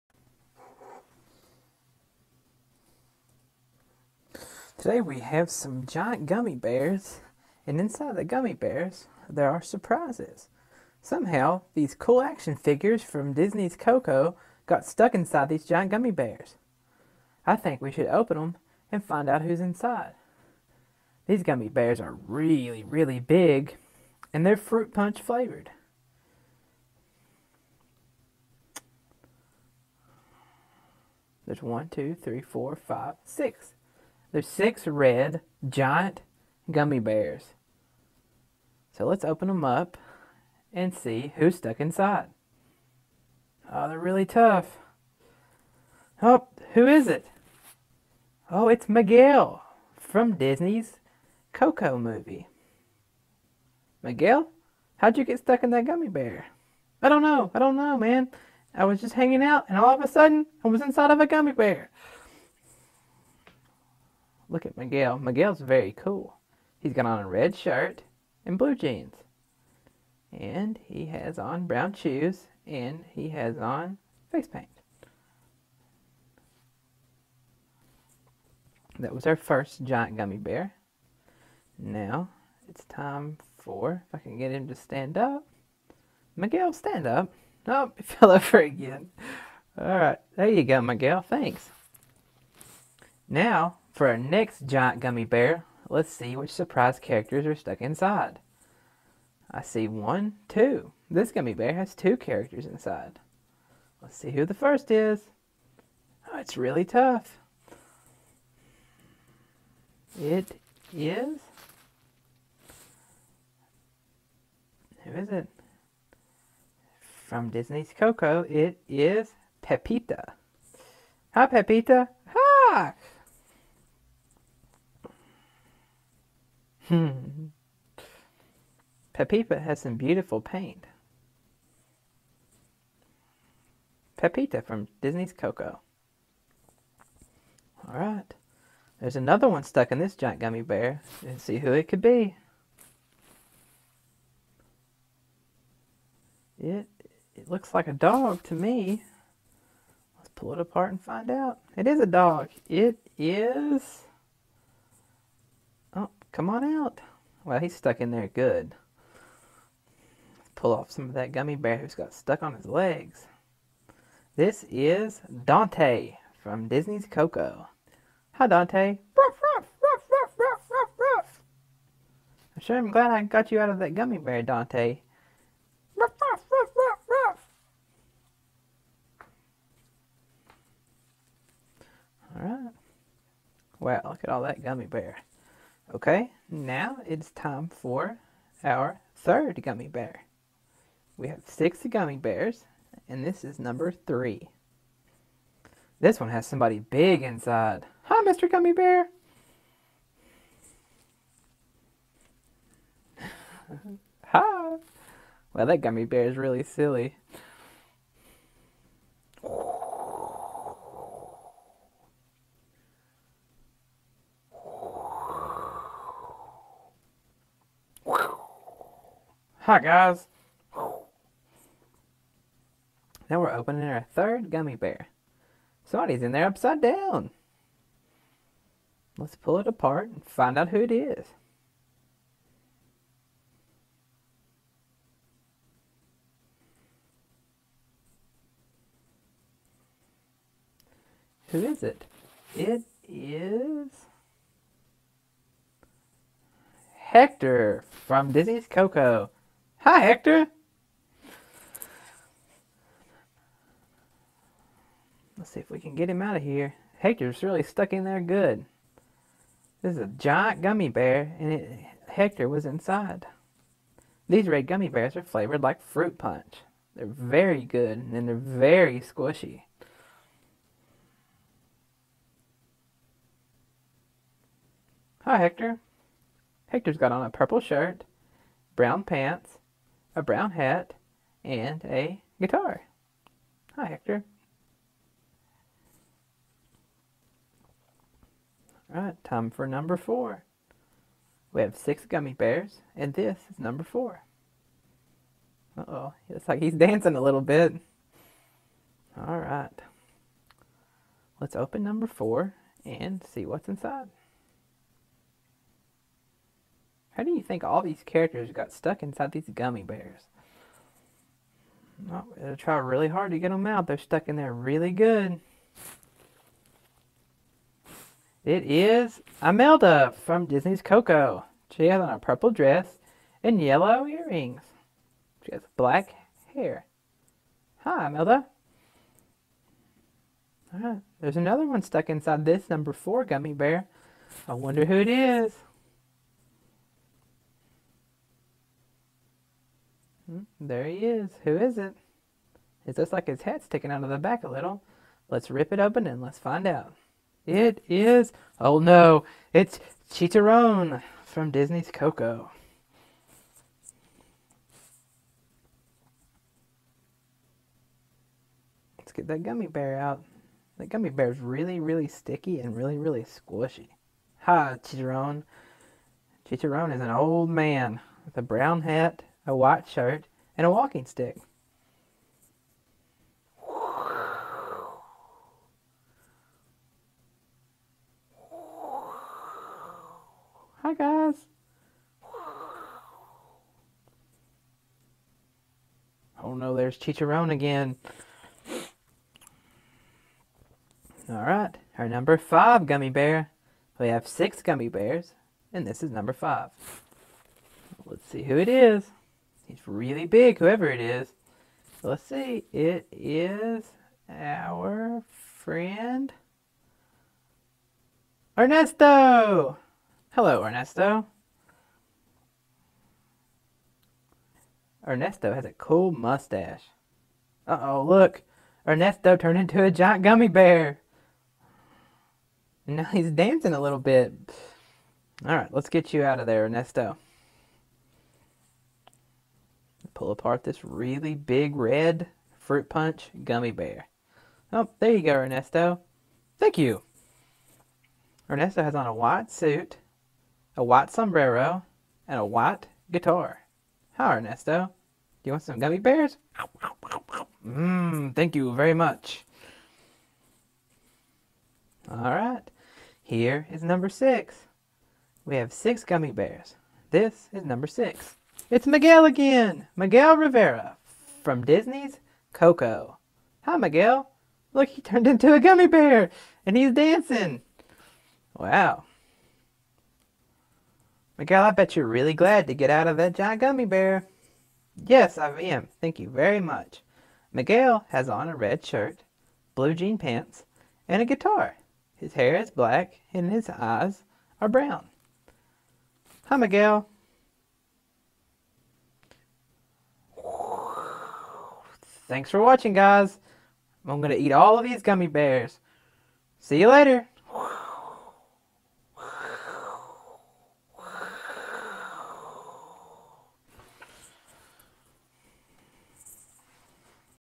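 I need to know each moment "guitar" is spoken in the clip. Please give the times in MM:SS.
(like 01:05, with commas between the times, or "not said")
04:42, 07:23, 08:01.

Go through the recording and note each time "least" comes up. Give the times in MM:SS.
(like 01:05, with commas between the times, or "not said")
not said.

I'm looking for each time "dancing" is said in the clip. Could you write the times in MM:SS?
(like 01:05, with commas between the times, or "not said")
04:56, 07:03, 07:46.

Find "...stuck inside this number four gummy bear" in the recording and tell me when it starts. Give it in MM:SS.
05:31.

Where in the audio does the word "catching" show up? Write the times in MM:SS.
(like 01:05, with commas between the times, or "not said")
not said.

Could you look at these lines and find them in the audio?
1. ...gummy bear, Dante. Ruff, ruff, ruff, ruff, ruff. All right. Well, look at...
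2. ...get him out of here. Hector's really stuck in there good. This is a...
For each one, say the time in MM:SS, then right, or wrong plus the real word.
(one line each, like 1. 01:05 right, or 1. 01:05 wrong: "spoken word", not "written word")
1. 02:53 right
2. 04:15 right.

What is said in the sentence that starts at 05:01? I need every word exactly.
Let's open number four and see what's inside.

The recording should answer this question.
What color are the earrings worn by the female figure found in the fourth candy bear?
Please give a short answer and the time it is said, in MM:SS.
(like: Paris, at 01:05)
yellow, at 05:23.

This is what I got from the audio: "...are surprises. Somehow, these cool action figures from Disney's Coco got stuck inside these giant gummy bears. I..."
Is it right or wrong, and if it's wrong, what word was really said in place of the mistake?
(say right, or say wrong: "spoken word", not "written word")
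right.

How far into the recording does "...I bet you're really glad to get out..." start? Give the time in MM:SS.
07:51.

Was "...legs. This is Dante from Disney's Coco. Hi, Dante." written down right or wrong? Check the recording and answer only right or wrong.
right.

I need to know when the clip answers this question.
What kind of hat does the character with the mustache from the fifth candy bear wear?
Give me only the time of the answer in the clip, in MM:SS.
07:20.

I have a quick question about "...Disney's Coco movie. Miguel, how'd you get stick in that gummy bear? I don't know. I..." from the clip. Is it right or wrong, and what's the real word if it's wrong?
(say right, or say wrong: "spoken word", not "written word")
wrong: "stuck", not "stick".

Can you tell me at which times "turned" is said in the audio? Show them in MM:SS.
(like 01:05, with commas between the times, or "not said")
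06:59, 07:45.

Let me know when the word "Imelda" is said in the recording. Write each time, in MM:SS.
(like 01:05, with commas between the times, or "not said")
05:19, 05:28.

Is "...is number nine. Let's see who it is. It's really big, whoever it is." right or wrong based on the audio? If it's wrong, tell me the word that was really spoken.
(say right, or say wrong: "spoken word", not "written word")
wrong: "five", not "nine".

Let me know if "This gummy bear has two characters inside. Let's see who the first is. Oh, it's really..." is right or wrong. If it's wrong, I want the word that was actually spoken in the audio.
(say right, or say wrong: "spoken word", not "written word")
right.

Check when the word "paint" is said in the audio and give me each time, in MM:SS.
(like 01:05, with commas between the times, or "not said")
01:14, 02:10.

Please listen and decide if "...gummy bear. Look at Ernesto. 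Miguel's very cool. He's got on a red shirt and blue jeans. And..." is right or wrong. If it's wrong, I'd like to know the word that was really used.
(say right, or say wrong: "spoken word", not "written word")
wrong: "Miguel", not "Ernesto".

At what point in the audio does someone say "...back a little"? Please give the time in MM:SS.
05:44.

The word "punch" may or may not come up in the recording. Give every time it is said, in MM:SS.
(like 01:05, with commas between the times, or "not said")
00:24, 04:26, 07:12.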